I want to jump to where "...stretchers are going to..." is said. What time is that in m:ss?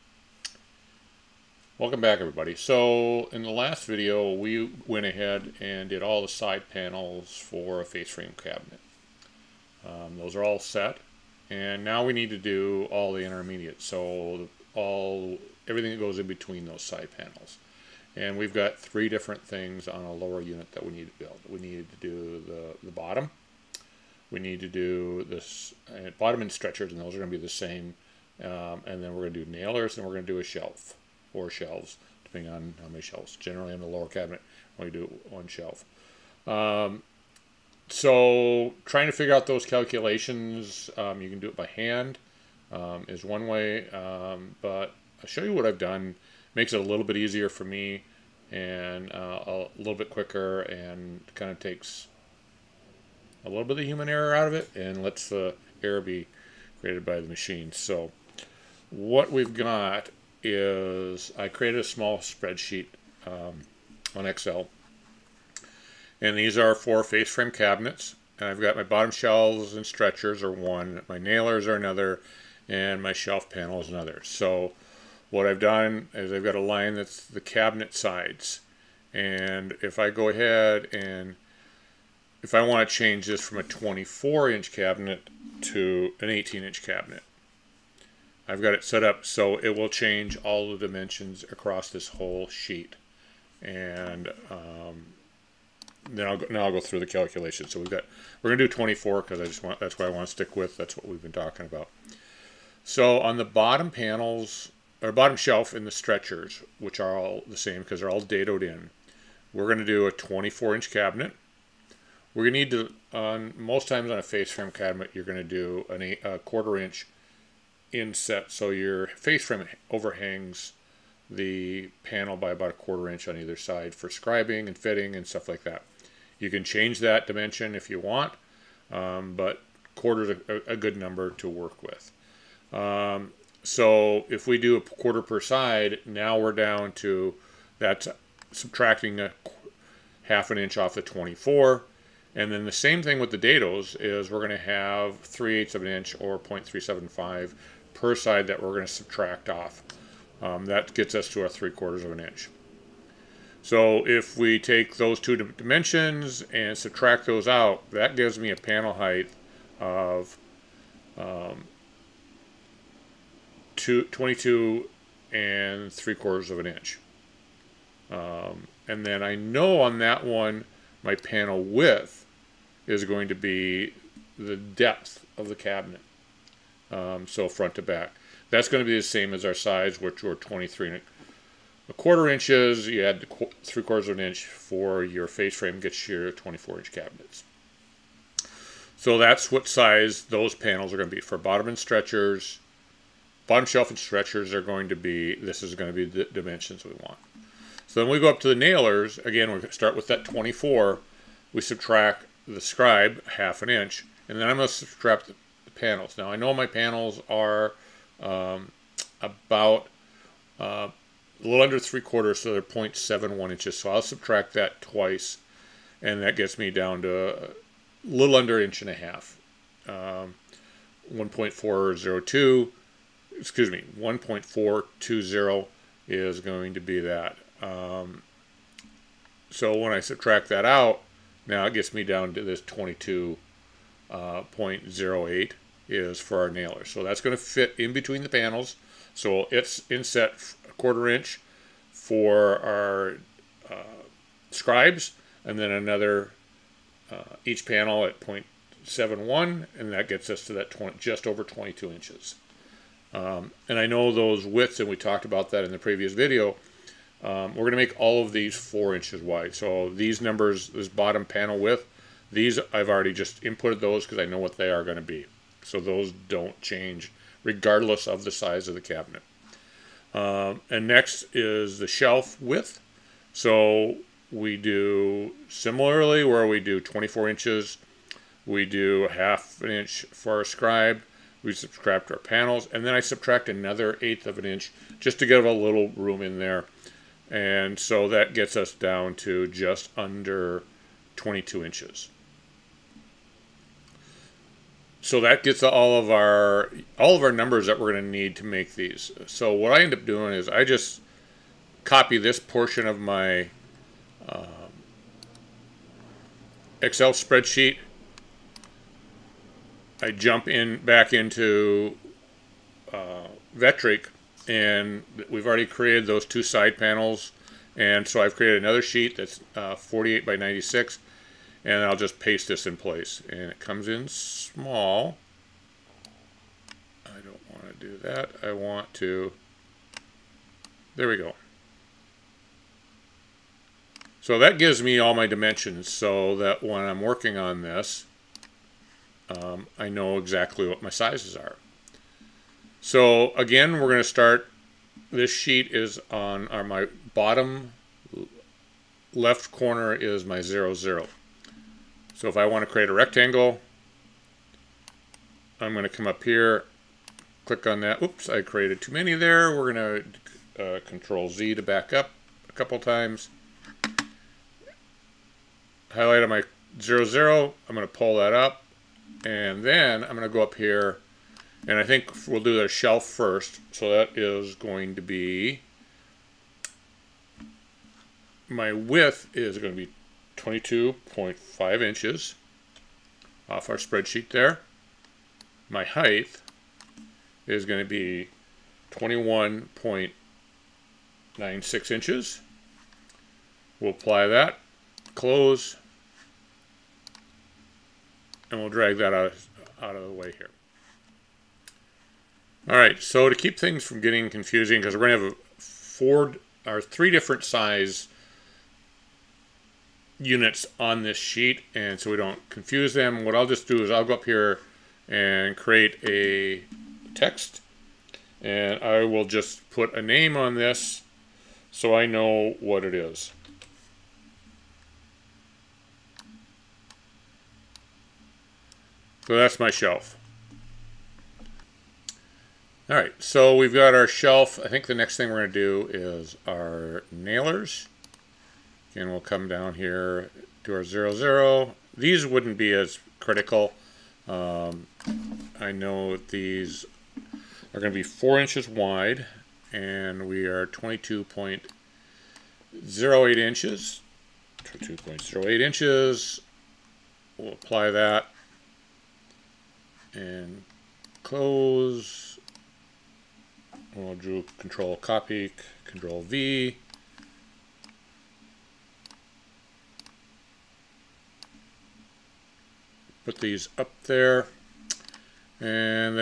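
3:13.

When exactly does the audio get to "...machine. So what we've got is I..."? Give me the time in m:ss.
0:57.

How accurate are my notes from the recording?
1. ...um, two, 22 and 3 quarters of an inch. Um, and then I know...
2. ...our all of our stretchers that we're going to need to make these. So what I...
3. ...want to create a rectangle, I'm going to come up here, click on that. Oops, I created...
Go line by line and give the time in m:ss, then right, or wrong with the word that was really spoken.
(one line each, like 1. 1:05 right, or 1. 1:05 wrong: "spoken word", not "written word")
1. 2:41 right
2. 4:56 wrong: "numbers", not "stretchers"
3. 5:52 right.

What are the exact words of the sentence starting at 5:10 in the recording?
I jump in back into uh, Vetric, and we've already created those two side panels.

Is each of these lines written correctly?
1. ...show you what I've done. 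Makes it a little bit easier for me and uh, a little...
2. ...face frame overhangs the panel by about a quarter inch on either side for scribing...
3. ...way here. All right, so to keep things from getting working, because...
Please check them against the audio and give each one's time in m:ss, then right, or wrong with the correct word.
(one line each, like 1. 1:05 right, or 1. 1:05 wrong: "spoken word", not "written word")
1. 0:45 right
2. 1:59 right
3. 6:40 wrong: "confusing", not "working".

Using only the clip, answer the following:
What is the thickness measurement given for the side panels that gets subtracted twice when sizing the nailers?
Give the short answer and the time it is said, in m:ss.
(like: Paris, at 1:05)
0.71 inches, at 3:32.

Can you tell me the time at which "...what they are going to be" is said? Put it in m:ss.
4:24.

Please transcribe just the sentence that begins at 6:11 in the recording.
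And I think we'll do the shelf first.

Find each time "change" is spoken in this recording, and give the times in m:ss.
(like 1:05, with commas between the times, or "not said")
1:22, 1:29, 2:06, 4:26.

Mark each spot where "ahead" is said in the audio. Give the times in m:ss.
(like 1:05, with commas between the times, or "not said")
0:05, 1:20.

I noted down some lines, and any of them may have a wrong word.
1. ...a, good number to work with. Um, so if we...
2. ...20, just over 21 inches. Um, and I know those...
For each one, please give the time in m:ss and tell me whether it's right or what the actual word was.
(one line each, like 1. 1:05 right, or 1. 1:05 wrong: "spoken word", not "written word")
1. 2:10 right
2. 4:10 wrong: "22", not "21".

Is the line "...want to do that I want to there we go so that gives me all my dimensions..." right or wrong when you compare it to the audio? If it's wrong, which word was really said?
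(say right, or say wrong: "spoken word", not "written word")
right.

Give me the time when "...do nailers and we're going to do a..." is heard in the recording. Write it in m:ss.
0:29.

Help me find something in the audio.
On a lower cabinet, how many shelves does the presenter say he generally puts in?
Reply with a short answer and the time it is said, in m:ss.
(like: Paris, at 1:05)
1, at 0:34.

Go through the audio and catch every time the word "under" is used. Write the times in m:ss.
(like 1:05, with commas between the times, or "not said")
3:31, 3:38, 4:49.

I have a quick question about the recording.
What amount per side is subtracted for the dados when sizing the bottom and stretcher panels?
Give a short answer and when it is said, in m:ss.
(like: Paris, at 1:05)
0.375 inches, at 2:26.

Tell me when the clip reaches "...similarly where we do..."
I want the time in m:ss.
4:35.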